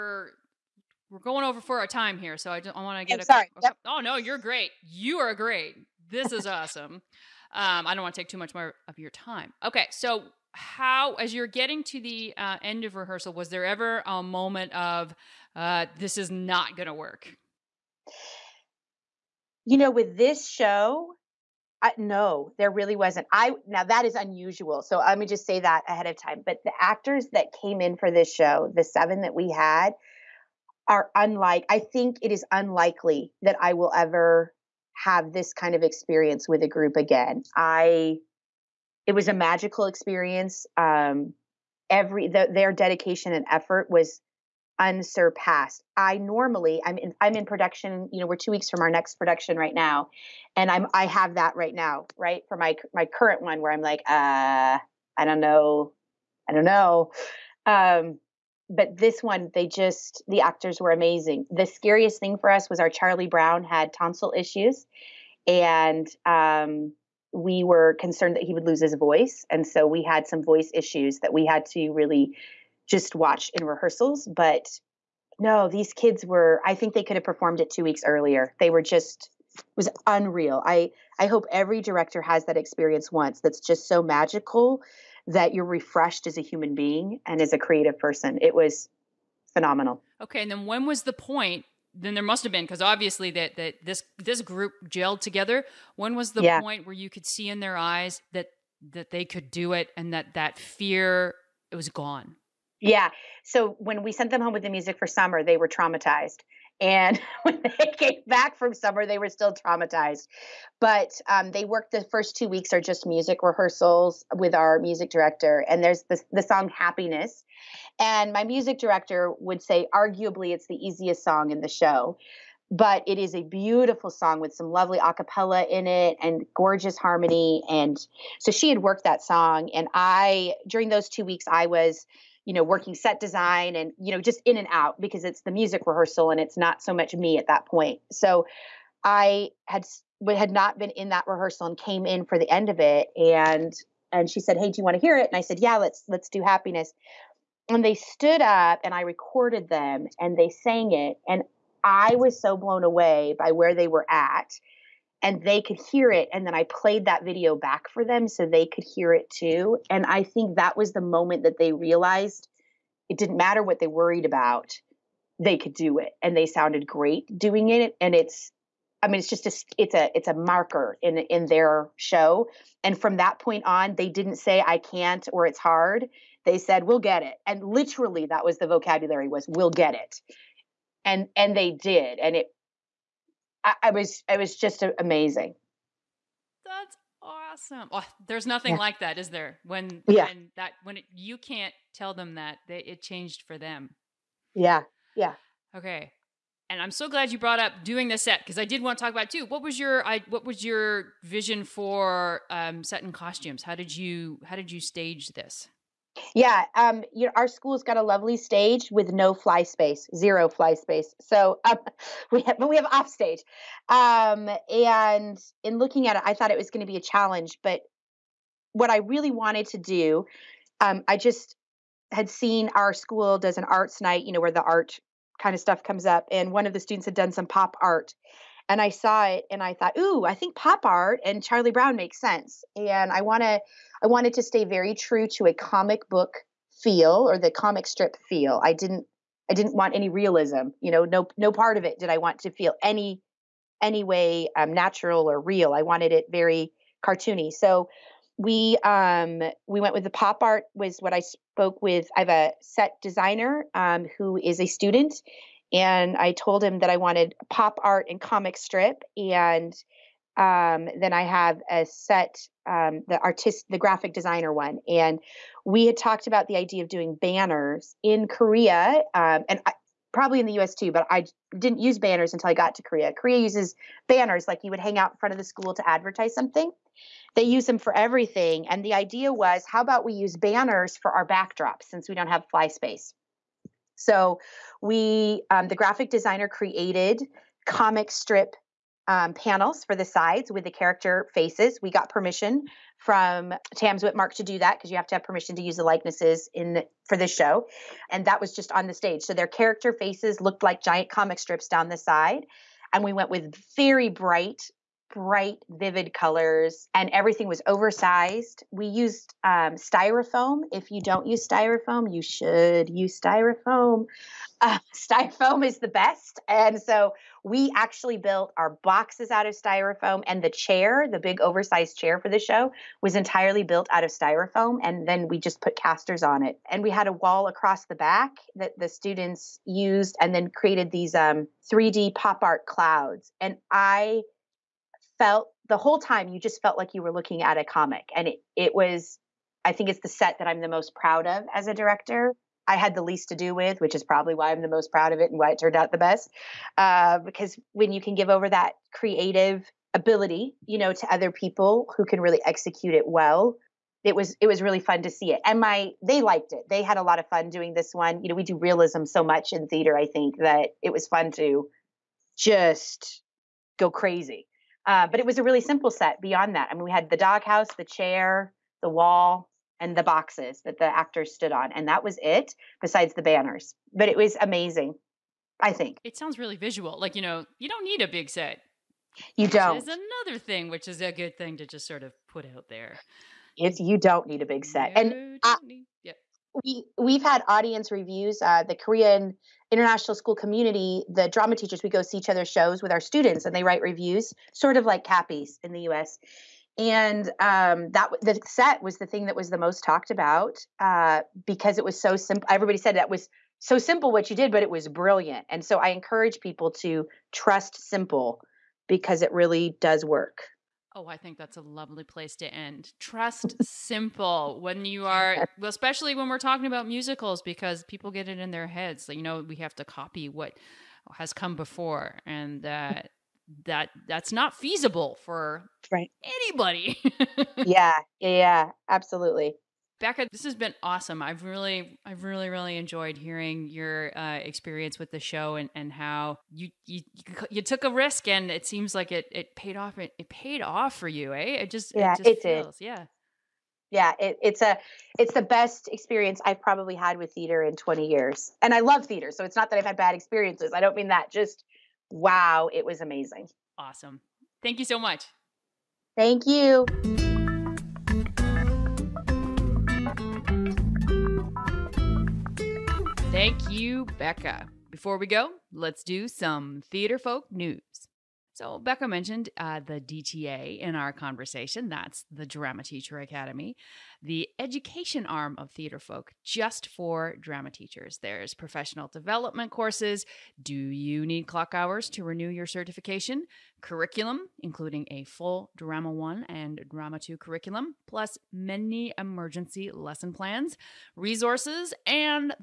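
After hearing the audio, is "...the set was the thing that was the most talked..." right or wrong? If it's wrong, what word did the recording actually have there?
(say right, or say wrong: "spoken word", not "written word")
right.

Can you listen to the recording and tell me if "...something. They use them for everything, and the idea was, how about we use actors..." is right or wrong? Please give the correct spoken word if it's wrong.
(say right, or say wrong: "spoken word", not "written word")
wrong: "banners", not "actors".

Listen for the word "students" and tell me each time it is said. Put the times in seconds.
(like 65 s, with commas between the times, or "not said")
226 s, 254 s, 328 s, 392 s.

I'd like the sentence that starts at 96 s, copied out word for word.
point where you could see in their eyes that that they could do it and that that fear it was gone yeah.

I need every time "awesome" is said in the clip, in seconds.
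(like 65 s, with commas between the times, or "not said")
6 s, 187 s, 430 s, 453 s.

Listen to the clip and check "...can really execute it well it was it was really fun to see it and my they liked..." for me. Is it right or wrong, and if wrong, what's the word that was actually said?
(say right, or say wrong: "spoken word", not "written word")
right.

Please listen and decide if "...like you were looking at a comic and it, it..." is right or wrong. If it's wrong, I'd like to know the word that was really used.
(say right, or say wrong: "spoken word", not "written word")
right.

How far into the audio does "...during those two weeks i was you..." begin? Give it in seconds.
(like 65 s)
130 s.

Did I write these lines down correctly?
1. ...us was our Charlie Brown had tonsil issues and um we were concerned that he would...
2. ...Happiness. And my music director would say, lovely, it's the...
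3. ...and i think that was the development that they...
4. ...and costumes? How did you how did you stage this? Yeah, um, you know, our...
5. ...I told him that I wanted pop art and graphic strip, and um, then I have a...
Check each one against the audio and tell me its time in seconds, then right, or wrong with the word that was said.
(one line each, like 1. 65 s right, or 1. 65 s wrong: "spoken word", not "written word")
1. 62 s right
2. 116 s wrong: "arguably", not "lovely"
3. 159 s wrong: "moment", not "development"
4. 203 s right
5. 256 s wrong: "comic", not "graphic".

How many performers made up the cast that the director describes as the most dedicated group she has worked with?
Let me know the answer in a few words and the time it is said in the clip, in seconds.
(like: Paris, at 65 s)
7, at 28 s.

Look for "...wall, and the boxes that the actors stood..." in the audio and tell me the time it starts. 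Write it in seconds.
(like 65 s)
368 s.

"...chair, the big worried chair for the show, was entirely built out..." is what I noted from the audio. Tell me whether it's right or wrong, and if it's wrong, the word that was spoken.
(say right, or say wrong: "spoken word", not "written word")
wrong: "oversized", not "worried".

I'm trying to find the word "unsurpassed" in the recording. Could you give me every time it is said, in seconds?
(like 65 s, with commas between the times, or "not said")
44 s.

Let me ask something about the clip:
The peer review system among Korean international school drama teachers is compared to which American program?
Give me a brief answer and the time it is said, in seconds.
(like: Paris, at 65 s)
Cappies, at 395 s.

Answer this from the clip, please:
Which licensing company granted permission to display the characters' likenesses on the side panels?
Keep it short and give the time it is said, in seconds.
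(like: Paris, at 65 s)
Tams-Witmark, at 293 s.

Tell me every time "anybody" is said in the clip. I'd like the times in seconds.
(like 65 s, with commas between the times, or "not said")
426 s.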